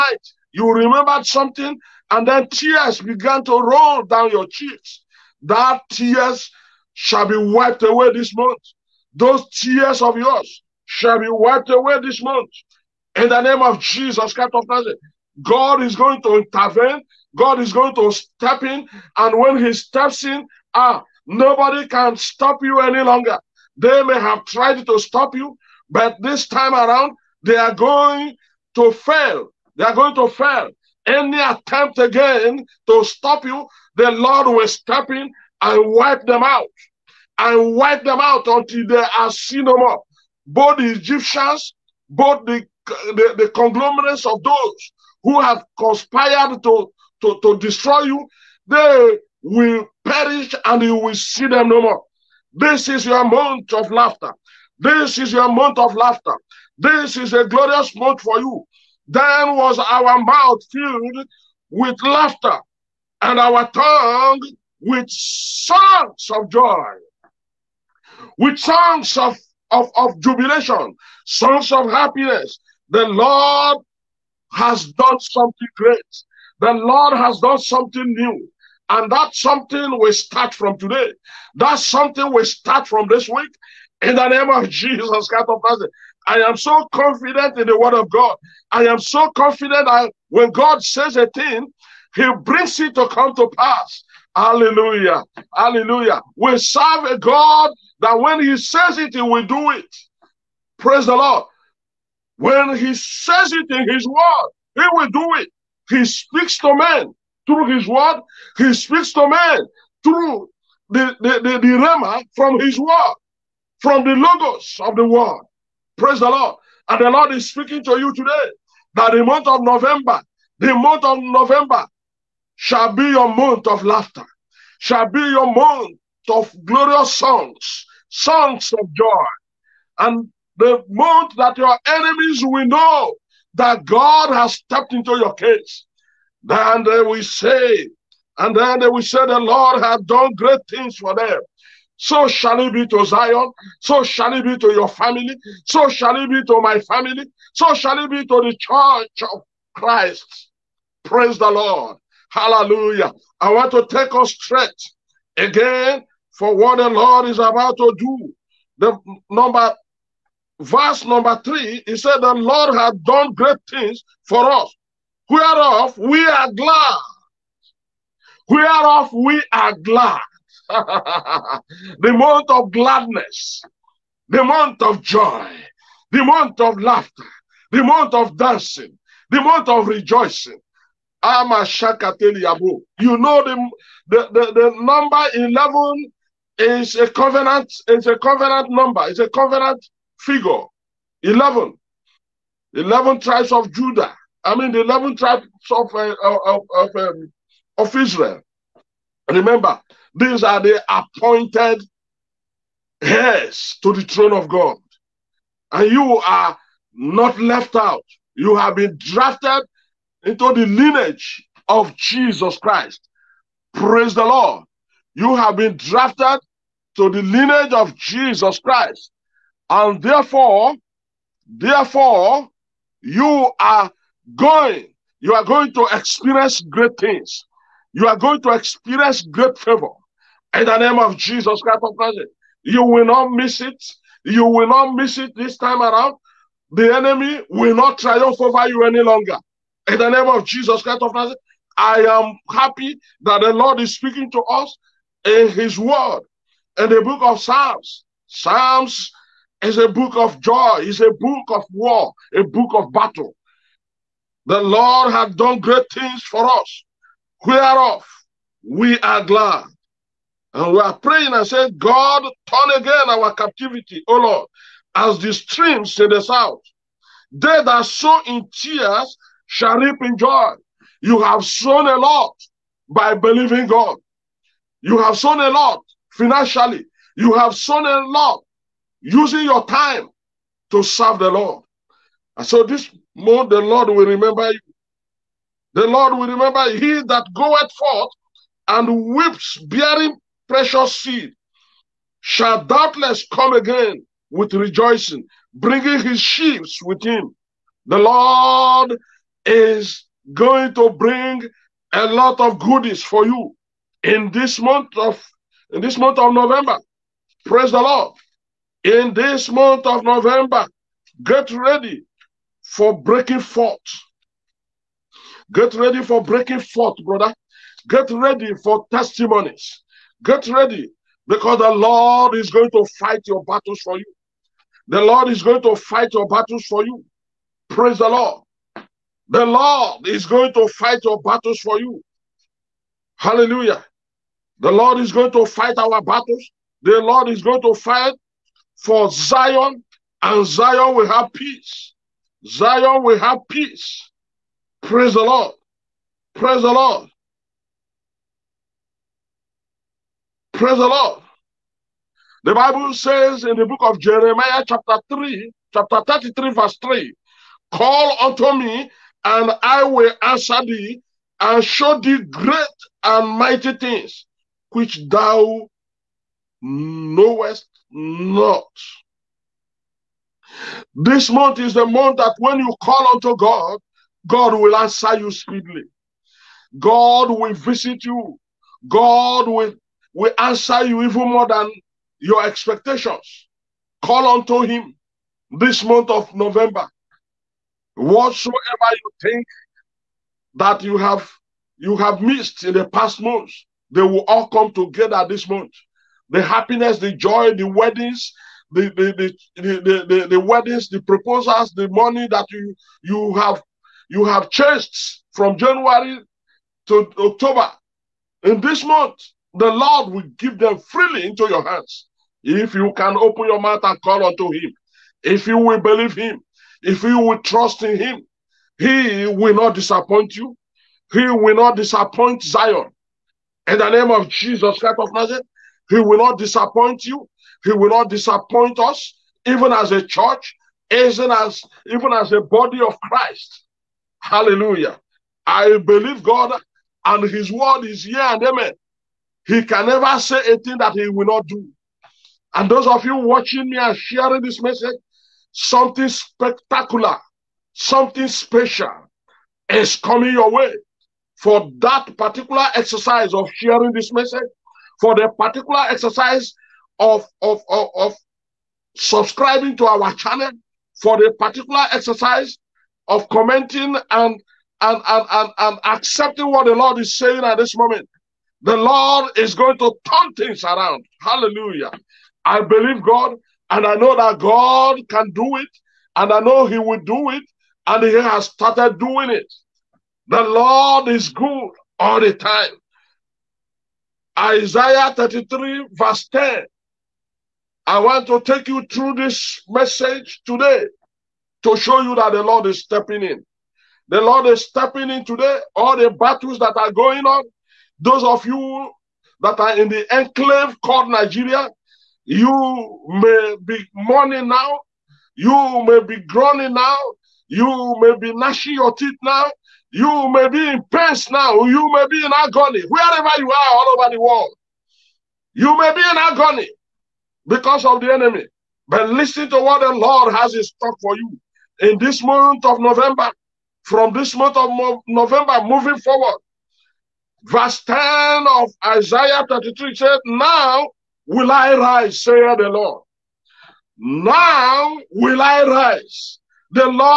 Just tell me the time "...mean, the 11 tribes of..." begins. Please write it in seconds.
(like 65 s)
194 s.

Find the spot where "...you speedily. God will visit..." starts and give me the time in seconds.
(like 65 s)
375 s.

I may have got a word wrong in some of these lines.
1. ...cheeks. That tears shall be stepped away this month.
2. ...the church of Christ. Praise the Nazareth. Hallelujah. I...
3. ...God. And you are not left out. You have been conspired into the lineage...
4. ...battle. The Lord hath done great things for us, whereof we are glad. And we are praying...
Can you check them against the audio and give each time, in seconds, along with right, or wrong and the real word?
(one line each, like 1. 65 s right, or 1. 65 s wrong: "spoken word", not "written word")
1. 4 s wrong: "wiped", not "stepped"
2. 148 s wrong: "Lord", not "Nazareth"
3. 204 s wrong: "drafted", not "conspired"
4. 252 s right.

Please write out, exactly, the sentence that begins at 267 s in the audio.
They that sow in tears shall reap in joy.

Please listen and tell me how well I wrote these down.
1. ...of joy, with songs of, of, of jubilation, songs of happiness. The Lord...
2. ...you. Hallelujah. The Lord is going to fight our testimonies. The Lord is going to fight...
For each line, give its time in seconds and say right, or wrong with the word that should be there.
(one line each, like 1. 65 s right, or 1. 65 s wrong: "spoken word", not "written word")
1. 66 s right
2. 331 s wrong: "battles", not "testimonies".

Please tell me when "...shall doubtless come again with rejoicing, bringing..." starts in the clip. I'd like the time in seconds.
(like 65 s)
292 s.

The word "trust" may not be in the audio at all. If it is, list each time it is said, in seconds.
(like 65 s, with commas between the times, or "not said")
417 s.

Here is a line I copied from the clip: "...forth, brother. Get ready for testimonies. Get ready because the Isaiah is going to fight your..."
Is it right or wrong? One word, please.
wrong.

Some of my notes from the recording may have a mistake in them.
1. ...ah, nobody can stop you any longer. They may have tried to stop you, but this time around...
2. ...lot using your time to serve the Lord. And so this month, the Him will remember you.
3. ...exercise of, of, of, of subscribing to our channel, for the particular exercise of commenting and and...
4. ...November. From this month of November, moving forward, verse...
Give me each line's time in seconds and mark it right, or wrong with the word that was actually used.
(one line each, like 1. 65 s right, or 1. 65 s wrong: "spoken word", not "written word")
1. 20 s right
2. 278 s wrong: "Lord", not "Him"
3. 455 s right
4. 522 s right.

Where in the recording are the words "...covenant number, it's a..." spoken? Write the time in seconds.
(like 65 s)
188 s.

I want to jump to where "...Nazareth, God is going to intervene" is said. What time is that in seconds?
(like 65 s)
14 s.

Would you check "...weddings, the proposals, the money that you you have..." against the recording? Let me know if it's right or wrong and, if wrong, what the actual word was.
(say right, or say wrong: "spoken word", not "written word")
right.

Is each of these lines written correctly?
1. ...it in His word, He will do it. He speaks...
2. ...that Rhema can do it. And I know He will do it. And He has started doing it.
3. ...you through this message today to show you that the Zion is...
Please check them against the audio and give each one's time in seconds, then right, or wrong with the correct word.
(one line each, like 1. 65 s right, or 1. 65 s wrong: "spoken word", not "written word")
1. 103 s right
2. 474 s wrong: "God", not "Rhema"
3. 488 s wrong: "Lord", not "Zion".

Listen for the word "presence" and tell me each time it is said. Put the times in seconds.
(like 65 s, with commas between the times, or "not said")
not said.